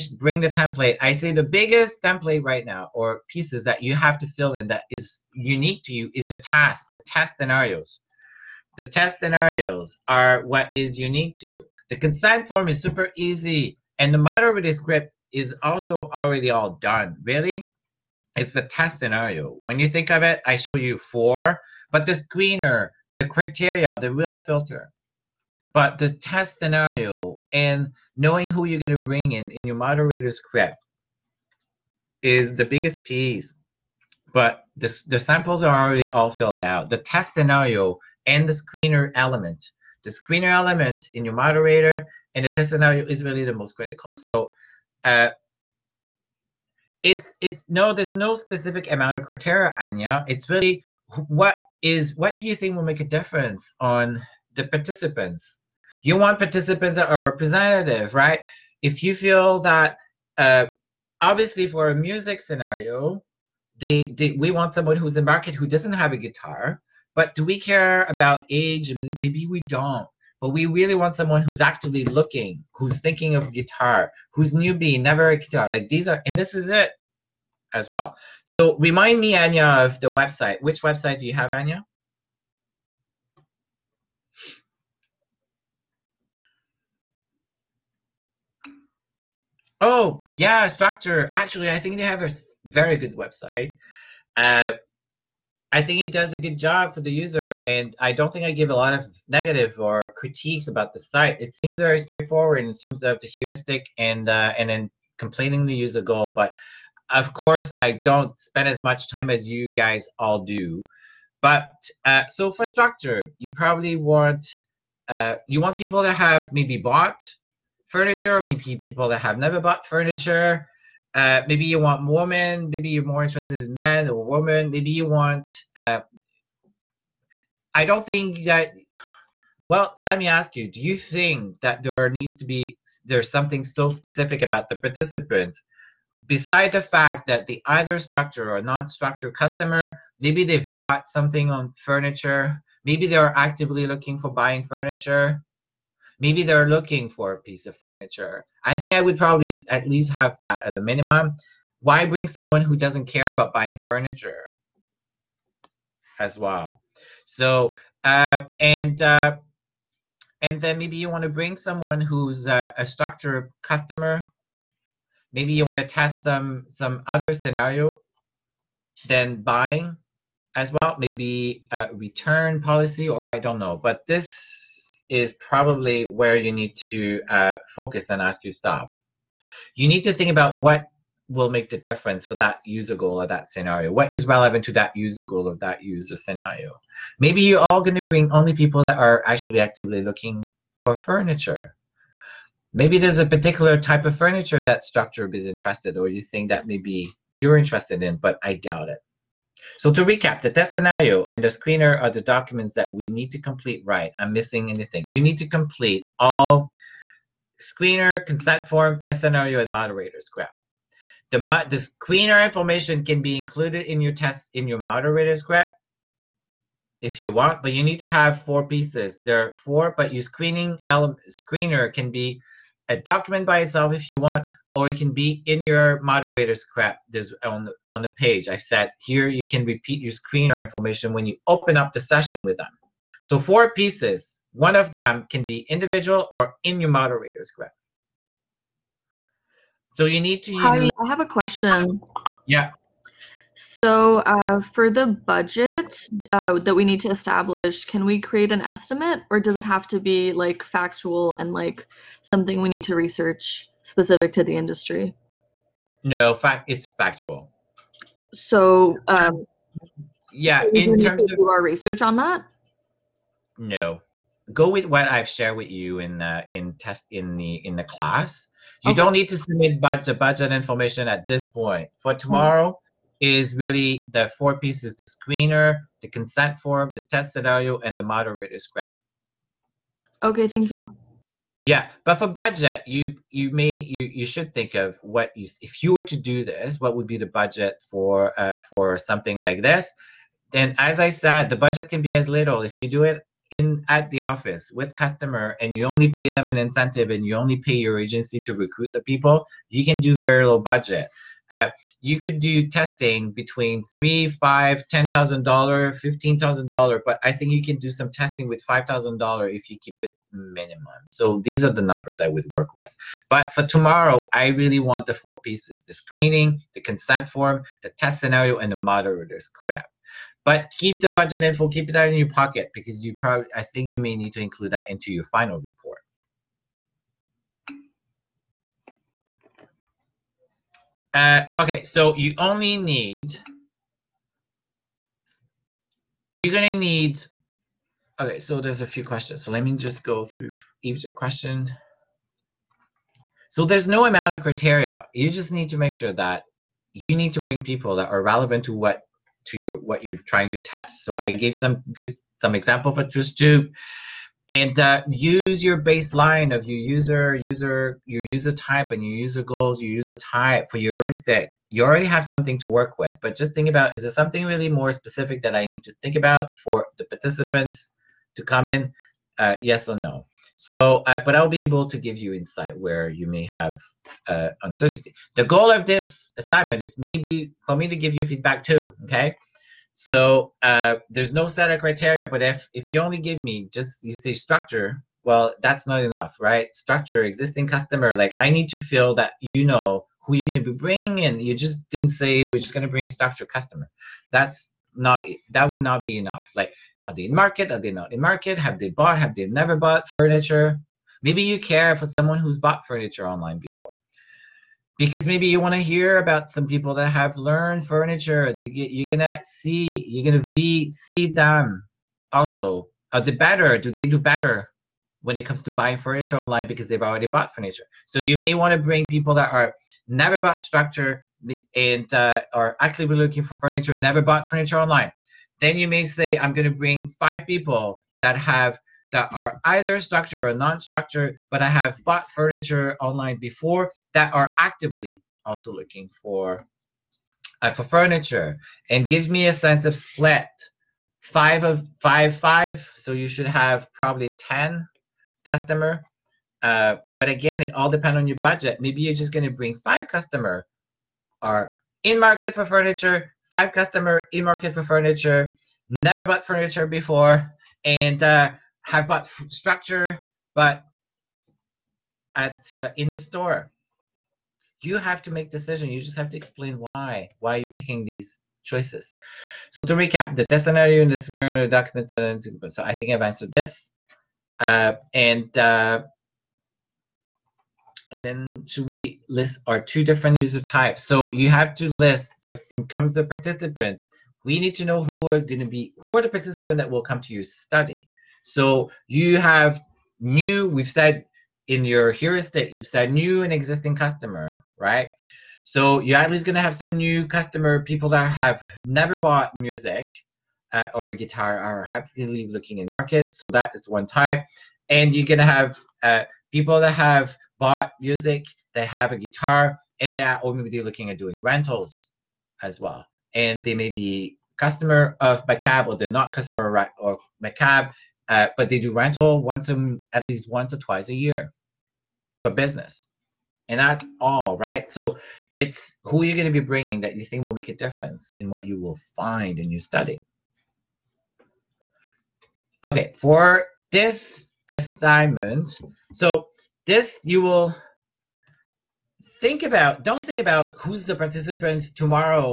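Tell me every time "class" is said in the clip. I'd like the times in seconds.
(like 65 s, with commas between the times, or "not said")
267 s.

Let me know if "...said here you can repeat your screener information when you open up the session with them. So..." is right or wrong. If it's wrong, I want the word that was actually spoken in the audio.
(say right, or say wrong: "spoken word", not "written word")
right.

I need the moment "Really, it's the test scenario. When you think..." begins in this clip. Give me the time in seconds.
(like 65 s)
17 s.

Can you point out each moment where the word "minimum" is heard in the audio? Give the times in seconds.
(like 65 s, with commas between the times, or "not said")
150 s, 310 s.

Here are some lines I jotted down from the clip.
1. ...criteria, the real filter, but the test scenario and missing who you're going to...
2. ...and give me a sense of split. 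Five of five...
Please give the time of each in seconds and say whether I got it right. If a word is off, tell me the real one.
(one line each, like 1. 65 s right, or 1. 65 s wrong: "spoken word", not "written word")
1. 23 s wrong: "knowing", not "missing"
2. 438 s right.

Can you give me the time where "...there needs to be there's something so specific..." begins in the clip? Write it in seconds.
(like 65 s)
131 s.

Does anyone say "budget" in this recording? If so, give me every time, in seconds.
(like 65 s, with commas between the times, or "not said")
245 s, 270 s, 282 s, 287 s, 291 s, 300 s, 321 s, 448 s.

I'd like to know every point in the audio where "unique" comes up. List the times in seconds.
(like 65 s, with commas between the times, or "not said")
5 s, 10 s.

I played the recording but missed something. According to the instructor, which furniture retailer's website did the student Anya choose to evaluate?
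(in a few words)
Spectre.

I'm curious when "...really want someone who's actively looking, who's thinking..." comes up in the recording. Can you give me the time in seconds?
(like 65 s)
70 s.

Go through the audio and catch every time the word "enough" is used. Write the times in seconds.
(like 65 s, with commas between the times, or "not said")
386 s, 396 s.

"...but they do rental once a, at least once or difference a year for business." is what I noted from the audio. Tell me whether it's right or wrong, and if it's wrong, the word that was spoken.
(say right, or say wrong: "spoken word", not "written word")
wrong: "twice", not "difference".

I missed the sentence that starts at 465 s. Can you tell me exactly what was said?
You just have to explain why why you're picking these choices.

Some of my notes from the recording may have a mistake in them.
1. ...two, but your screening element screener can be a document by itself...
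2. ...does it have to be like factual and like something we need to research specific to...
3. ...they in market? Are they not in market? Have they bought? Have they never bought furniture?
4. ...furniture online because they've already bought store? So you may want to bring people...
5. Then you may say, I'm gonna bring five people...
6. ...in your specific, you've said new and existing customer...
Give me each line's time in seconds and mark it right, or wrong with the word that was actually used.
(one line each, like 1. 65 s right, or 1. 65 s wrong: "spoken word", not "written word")
1. 219 s wrong: "four", not "two"
2. 249 s right
3. 397 s right
4. 415 s wrong: "furniture", not "store"
5. 425 s right
6. 491 s wrong: "heuristic", not "specific".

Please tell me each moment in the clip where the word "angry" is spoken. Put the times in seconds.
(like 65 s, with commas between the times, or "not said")
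not said.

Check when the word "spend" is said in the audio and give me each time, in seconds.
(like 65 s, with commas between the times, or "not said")
108 s.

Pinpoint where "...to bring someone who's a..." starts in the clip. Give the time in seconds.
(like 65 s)
161 s.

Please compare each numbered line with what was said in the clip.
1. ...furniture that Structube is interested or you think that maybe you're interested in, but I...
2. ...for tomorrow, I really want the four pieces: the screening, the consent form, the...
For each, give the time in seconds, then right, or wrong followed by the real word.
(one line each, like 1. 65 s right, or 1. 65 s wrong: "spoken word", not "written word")
1. 194 s right
2. 313 s right.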